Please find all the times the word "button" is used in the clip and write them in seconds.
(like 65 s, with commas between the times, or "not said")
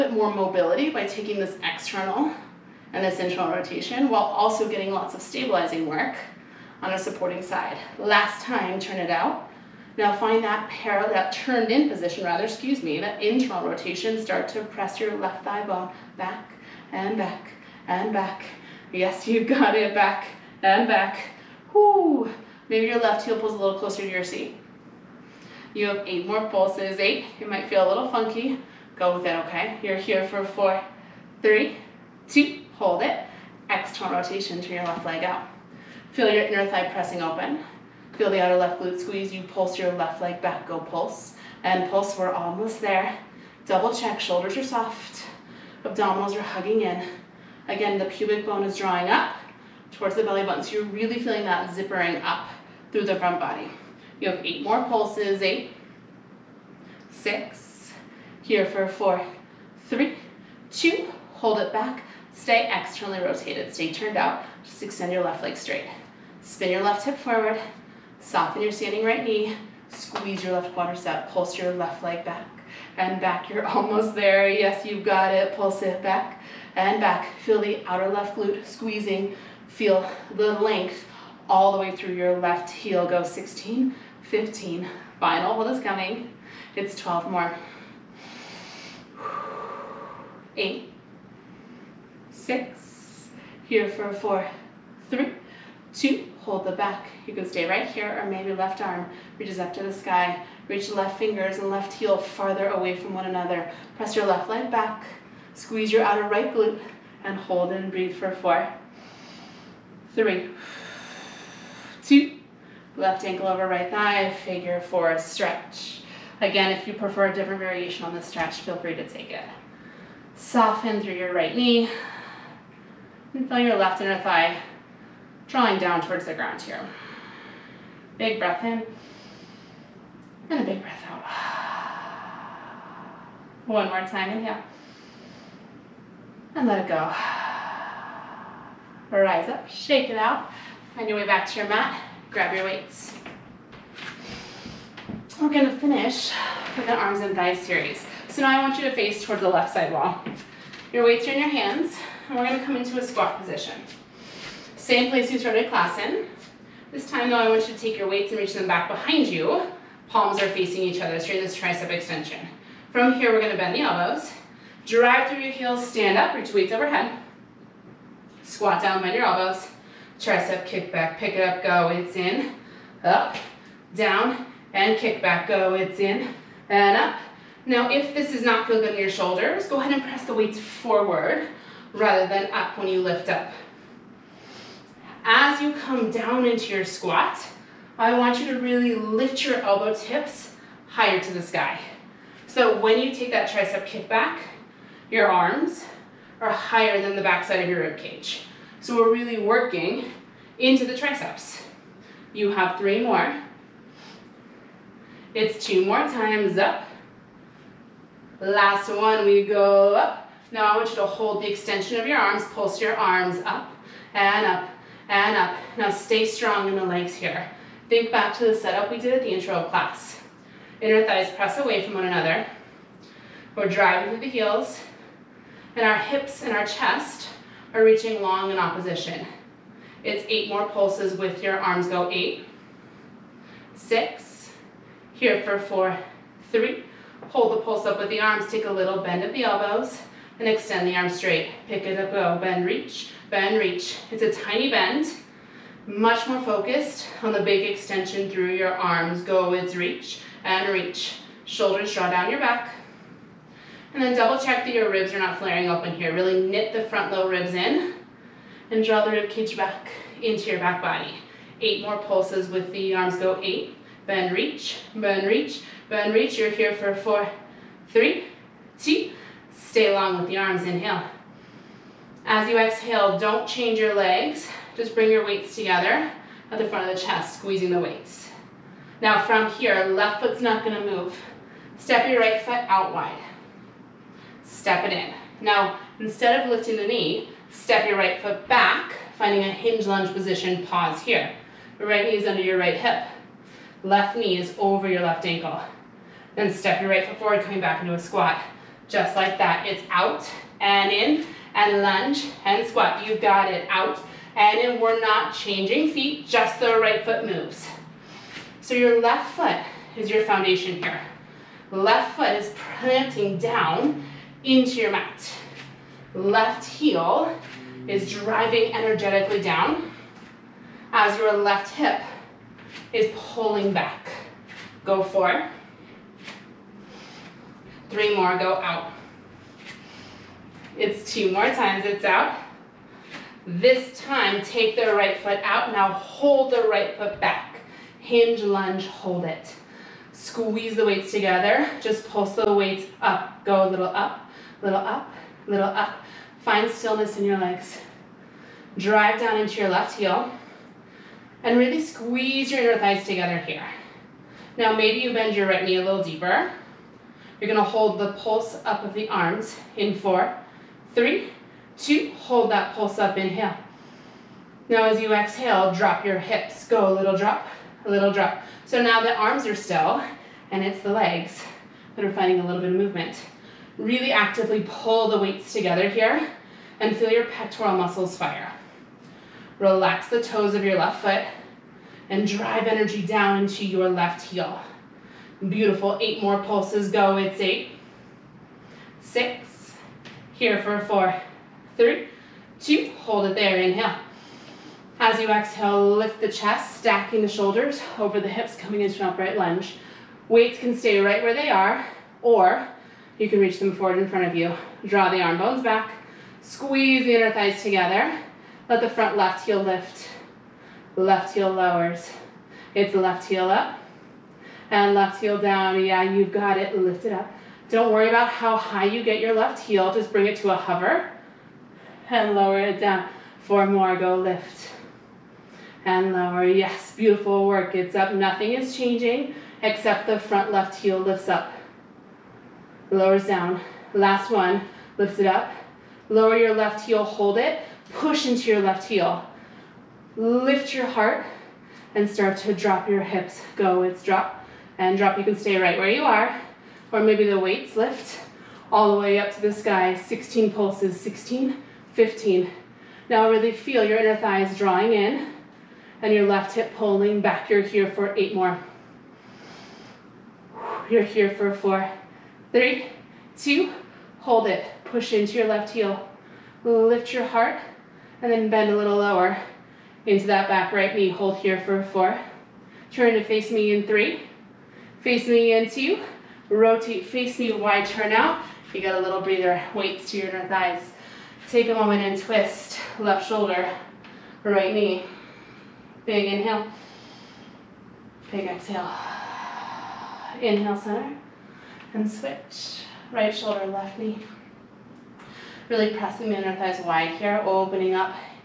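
50 s.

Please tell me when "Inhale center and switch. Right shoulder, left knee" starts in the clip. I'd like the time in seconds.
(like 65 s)
490 s.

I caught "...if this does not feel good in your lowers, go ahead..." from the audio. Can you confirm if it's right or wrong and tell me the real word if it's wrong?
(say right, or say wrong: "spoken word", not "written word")
wrong: "shoulders", not "lowers".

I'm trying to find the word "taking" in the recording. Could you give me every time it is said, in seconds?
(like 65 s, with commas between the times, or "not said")
1 s.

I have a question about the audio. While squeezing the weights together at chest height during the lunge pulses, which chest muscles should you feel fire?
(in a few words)
pectoral muscles.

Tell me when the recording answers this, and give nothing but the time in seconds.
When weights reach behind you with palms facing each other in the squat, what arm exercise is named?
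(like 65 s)
161 s.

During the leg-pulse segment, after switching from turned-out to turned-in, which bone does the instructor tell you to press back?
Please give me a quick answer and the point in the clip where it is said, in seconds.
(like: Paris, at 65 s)
left thigh bone, at 15 s.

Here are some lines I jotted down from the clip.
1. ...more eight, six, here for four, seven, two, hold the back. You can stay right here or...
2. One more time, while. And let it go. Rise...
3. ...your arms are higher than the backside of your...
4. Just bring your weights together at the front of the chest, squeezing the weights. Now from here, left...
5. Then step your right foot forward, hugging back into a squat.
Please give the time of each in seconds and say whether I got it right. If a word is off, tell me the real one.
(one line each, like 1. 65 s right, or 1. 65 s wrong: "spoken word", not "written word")
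1. 87 s wrong: "three", not "seven"
2. 133 s wrong: "inhale", not "while"
3. 195 s right
4. 274 s right
5. 296 s wrong: "coming", not "hugging".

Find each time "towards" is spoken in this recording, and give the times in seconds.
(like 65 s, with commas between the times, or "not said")
49 s, 126 s, 149 s.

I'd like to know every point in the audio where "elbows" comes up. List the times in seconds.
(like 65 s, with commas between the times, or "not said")
163 s, 169 s, 189 s, 239 s.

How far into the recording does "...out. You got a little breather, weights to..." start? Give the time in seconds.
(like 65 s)
478 s.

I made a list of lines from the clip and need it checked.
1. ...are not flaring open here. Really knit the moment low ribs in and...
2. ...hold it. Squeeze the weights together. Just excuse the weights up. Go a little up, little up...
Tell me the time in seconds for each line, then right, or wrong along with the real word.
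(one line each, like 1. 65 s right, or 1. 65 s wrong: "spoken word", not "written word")
1. 255 s wrong: "front", not "moment"
2. 338 s wrong: "pulse", not "excuse".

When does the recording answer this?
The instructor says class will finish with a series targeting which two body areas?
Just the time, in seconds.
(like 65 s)
146 s.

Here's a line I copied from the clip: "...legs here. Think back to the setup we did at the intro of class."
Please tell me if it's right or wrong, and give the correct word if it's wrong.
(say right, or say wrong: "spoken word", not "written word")
right.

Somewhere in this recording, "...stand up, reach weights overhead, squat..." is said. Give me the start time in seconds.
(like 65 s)
165 s.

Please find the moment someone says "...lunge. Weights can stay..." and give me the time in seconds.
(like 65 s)
399 s.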